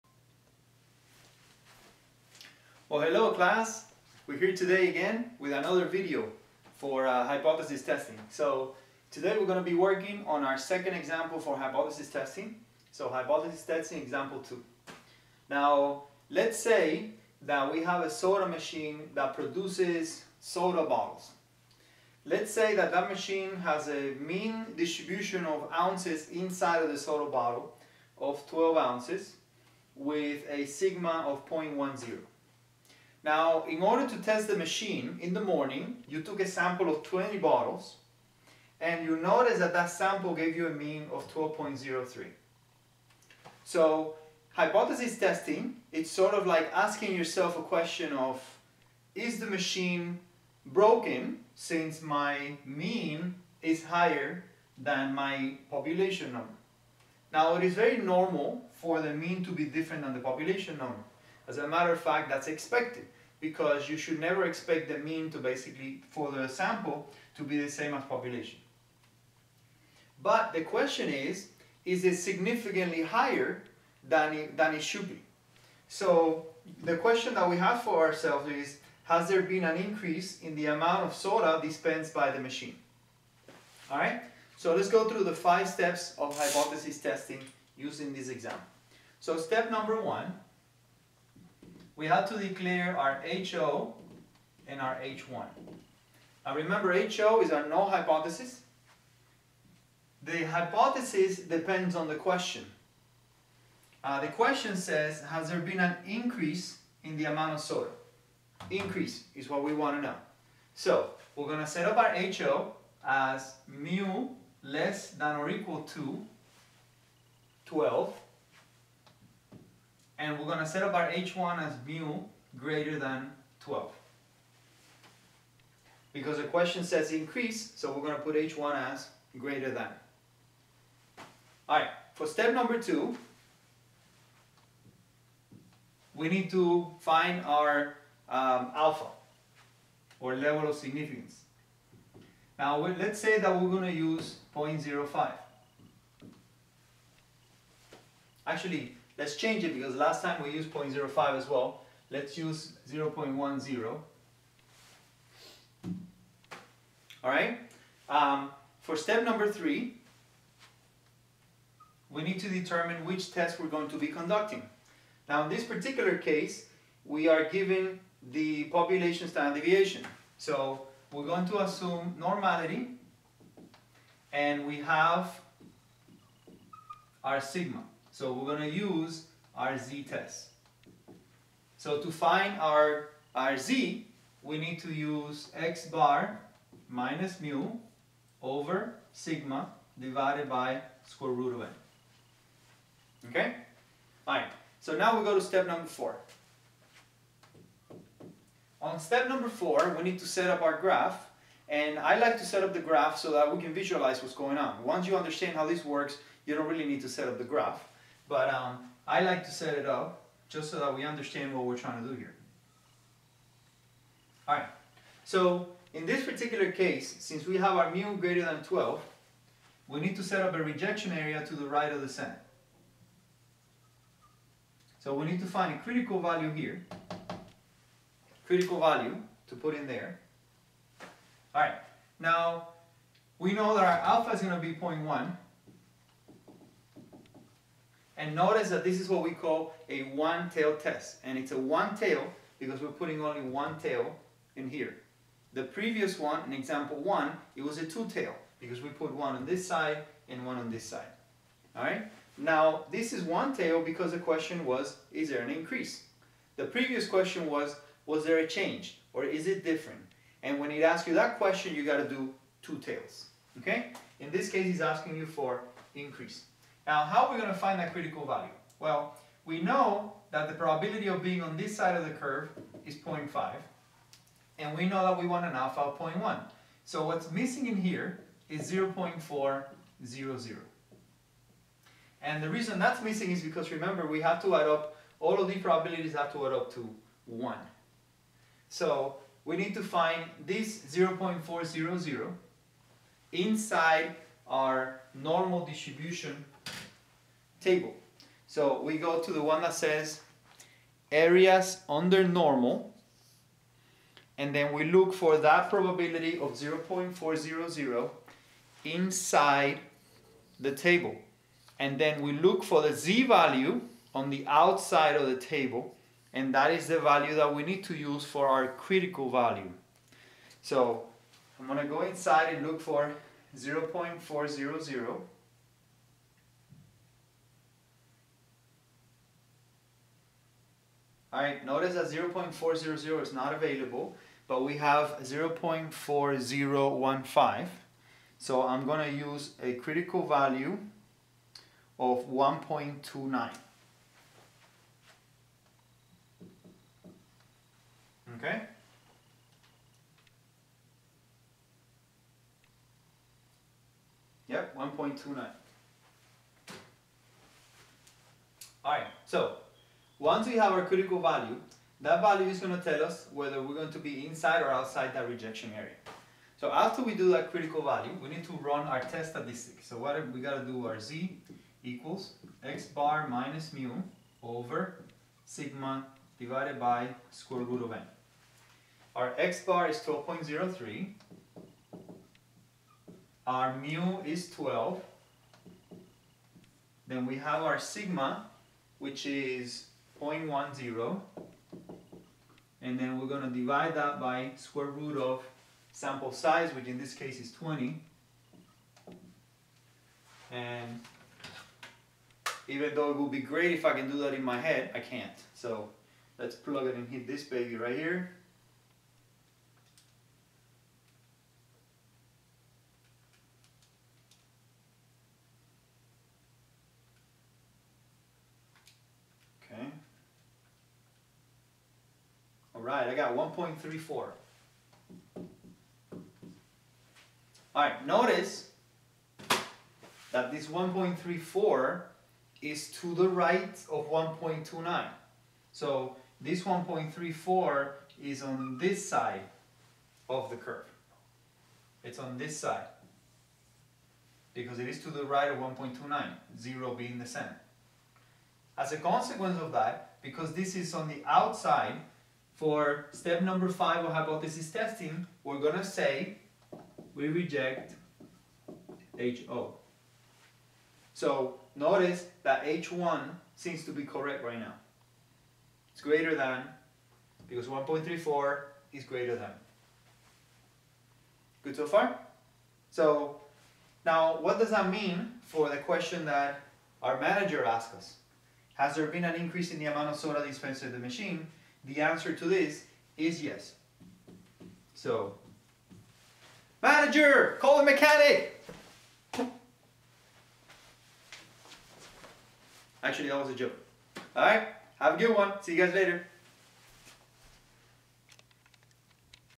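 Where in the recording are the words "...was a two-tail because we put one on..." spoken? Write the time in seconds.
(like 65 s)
247 s.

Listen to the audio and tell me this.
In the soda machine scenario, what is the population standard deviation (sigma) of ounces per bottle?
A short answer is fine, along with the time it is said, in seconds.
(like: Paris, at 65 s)
0.10, at 30 s.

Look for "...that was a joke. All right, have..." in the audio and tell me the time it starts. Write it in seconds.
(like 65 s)
493 s.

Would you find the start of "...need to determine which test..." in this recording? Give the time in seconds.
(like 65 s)
162 s.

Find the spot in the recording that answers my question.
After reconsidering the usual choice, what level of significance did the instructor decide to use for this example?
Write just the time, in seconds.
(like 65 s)
152 s.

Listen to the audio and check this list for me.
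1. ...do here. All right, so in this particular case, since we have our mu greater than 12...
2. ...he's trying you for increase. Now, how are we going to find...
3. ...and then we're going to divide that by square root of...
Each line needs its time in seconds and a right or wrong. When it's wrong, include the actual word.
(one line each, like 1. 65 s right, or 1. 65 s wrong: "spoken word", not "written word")
1. 212 s right
2. 264 s wrong: "asking", not "trying"
3. 392 s right.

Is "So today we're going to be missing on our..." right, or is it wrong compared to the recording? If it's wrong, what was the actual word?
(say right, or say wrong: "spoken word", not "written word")
wrong: "working", not "missing".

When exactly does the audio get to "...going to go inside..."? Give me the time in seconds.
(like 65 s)
321 s.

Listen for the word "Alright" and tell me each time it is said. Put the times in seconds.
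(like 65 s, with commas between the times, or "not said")
131 s, 331 s.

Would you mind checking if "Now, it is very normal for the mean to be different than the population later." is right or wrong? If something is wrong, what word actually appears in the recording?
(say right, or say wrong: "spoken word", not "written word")
wrong: "number", not "later".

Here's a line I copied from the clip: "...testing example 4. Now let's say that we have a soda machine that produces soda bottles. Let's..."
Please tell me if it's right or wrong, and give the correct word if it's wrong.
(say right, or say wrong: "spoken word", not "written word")
wrong: "2", not "4".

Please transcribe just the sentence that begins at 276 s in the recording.
So what's missing in here is 0.400.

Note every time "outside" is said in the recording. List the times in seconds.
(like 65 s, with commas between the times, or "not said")
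314 s, 364 s, 451 s.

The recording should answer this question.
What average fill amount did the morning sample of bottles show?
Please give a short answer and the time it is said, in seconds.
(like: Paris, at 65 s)
12.03, at 40 s.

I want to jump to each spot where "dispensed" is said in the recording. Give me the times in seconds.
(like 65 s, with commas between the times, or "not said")
81 s, 480 s.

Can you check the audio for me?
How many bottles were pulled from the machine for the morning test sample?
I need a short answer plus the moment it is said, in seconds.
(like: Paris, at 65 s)
20, at 37 s.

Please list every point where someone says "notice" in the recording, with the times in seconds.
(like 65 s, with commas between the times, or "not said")
39 s, 238 s, 331 s, 428 s, 461 s.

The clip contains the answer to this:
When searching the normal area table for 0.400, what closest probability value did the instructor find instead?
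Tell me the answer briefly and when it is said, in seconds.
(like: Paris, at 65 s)
0.4015, at 335 s.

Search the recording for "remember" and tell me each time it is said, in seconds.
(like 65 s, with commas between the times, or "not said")
96 s, 283 s.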